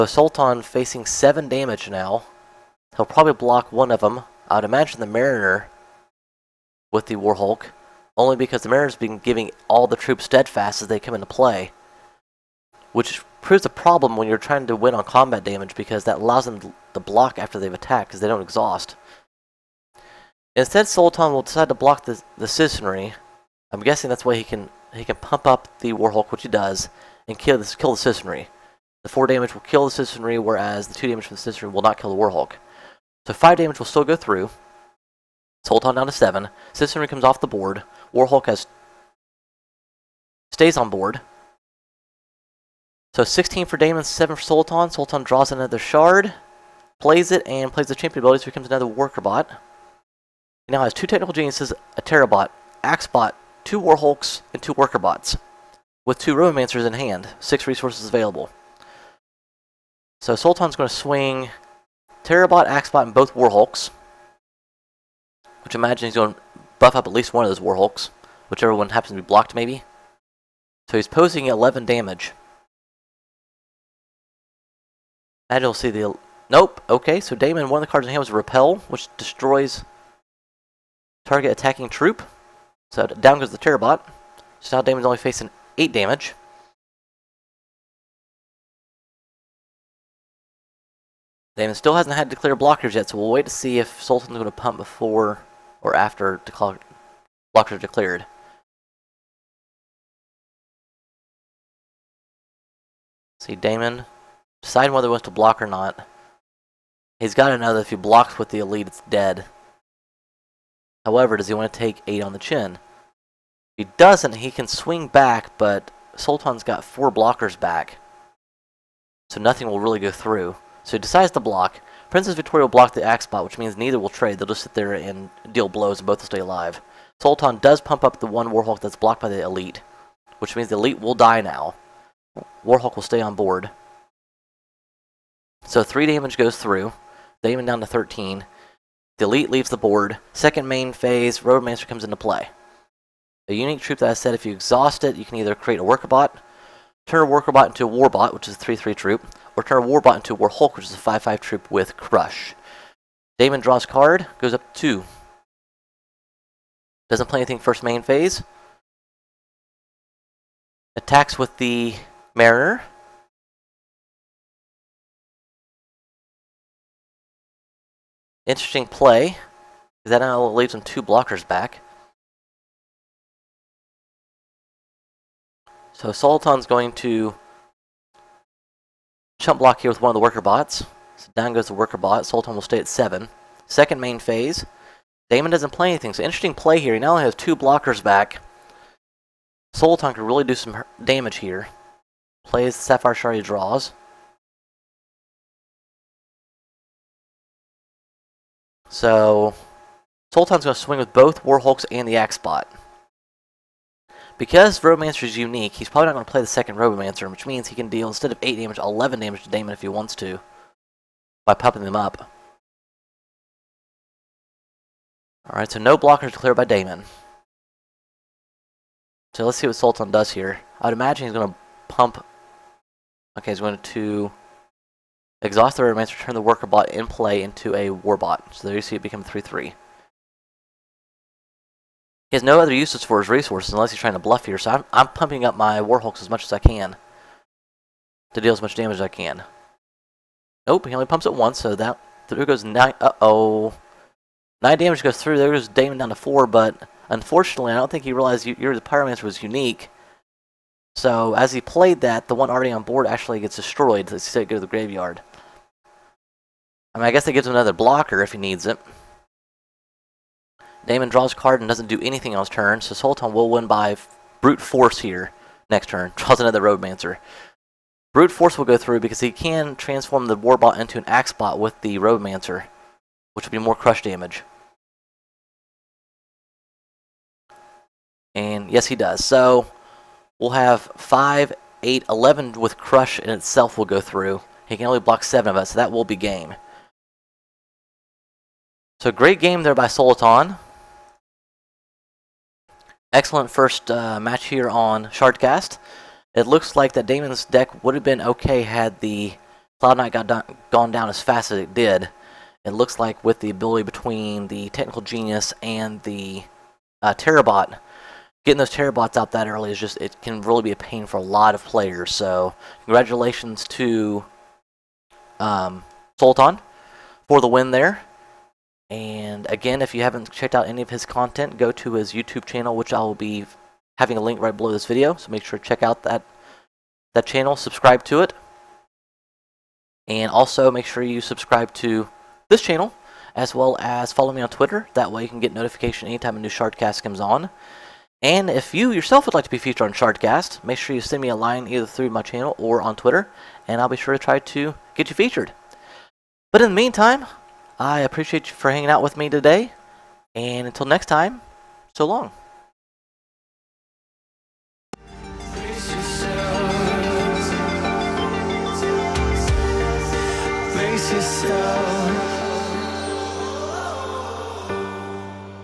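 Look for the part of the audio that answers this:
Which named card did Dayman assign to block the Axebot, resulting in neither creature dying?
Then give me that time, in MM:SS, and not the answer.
02:02.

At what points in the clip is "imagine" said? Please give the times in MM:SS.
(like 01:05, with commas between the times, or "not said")
00:04, 01:05, 03:40.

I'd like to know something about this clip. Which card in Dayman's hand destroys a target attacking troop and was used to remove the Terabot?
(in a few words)
Repel.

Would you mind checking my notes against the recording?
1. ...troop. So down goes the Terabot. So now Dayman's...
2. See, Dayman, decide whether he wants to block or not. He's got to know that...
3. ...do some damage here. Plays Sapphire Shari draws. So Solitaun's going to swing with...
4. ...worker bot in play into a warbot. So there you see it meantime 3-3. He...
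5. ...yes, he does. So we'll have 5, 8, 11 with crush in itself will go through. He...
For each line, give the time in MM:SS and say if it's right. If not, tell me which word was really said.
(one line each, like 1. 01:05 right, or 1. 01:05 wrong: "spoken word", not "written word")
1. 01:21 right
2. 01:43 right
3. 03:10 right
4. 03:46 wrong: "become", not "meantime"
5. 04:38 right.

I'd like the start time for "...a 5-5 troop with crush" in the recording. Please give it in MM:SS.
02:30.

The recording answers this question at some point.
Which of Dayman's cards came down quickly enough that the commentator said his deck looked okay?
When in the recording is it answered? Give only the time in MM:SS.
04:59.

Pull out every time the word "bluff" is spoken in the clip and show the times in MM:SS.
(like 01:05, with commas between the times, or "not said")
03:54.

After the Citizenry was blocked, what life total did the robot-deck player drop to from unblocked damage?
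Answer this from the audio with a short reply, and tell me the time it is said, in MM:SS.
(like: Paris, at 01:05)
7, at 00:35.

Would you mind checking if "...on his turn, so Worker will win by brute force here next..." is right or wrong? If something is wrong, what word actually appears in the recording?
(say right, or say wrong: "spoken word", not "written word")
wrong: "Solitaun", not "Worker".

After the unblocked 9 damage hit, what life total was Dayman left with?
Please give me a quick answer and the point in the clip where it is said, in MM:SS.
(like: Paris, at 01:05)
4, at 04:05.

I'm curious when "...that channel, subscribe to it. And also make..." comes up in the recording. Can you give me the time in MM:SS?
05:27.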